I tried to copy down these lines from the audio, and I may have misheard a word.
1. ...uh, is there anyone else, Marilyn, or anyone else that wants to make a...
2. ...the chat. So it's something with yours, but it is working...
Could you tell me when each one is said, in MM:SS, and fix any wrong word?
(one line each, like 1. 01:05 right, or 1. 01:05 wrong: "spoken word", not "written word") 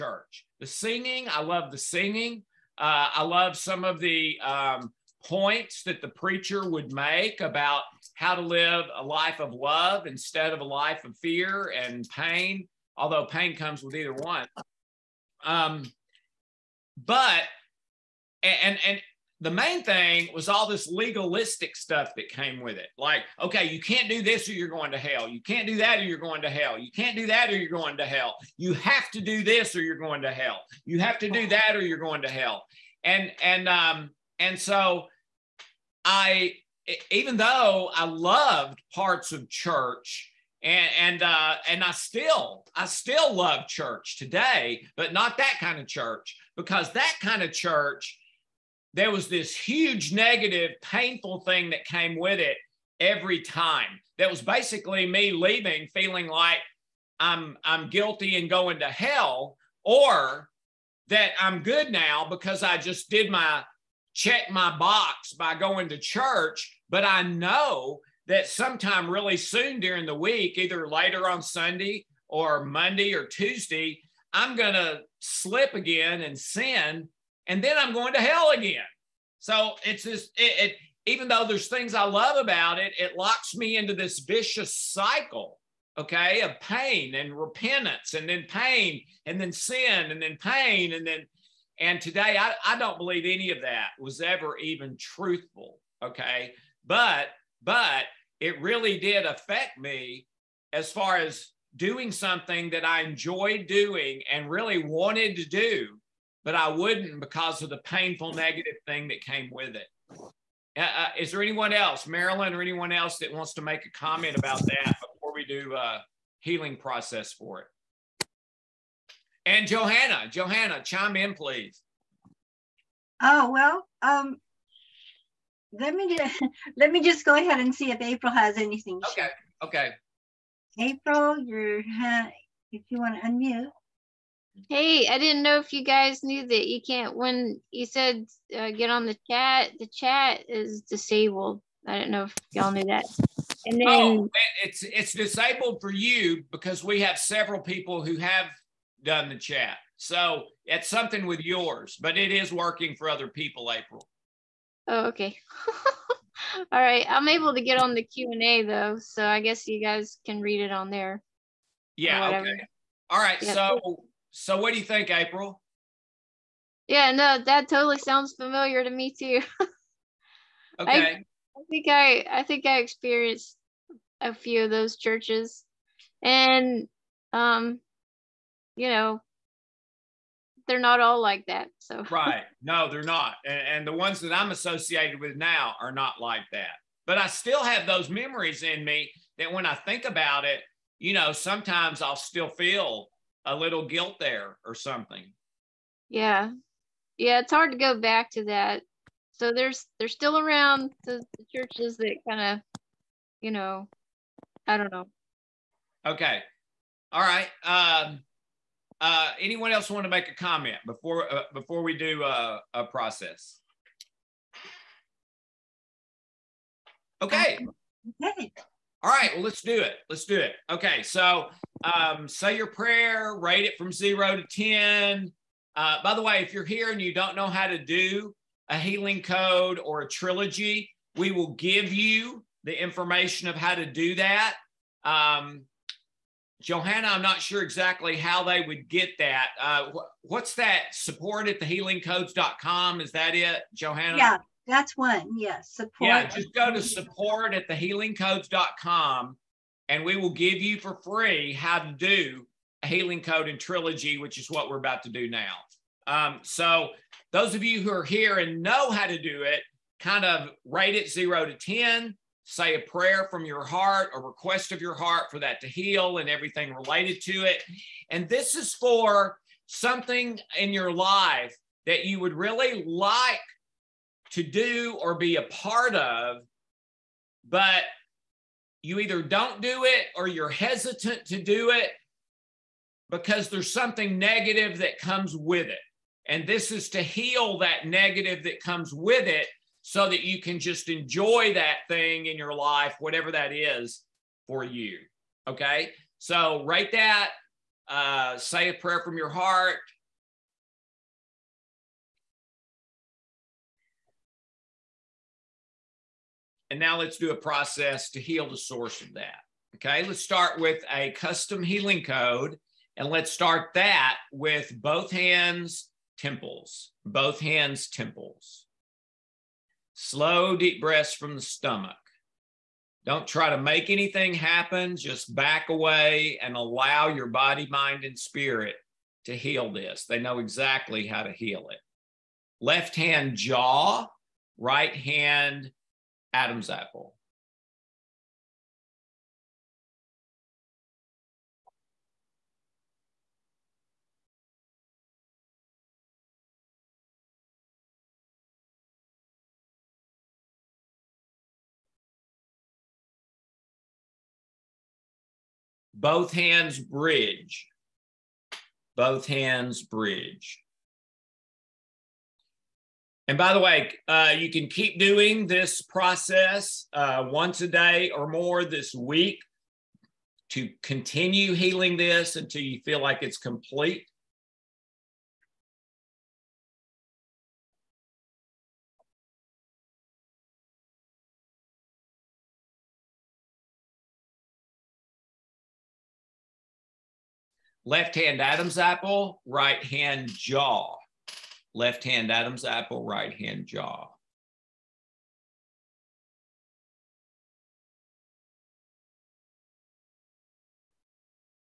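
1. 01:50 right
2. 02:29 right.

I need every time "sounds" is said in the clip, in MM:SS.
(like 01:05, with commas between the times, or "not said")
02:47.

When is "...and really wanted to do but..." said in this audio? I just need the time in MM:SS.
01:44.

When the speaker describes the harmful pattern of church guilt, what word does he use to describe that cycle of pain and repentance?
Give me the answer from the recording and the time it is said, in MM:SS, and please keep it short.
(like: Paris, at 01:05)
vicious, at 01:24.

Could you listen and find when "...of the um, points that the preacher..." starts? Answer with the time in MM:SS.
00:03.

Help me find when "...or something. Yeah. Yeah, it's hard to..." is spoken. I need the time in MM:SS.
03:14.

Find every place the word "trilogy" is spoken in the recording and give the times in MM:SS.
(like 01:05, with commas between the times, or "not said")
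03:50, 04:13.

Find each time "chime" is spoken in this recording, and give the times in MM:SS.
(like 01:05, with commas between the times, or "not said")
02:00.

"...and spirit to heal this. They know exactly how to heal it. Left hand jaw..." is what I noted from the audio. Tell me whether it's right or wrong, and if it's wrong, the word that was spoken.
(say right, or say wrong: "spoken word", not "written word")
right.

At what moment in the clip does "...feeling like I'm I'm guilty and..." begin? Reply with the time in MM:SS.
00:55.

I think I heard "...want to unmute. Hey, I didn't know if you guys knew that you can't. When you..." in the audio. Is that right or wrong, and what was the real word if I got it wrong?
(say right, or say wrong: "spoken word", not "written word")
right.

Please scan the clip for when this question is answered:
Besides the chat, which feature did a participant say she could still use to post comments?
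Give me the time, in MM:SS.
02:38.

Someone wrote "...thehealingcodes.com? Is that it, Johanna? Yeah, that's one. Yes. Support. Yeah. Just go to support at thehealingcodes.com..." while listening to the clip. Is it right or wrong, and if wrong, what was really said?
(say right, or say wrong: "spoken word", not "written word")
right.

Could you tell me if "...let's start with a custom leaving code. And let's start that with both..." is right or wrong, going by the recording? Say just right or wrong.
wrong.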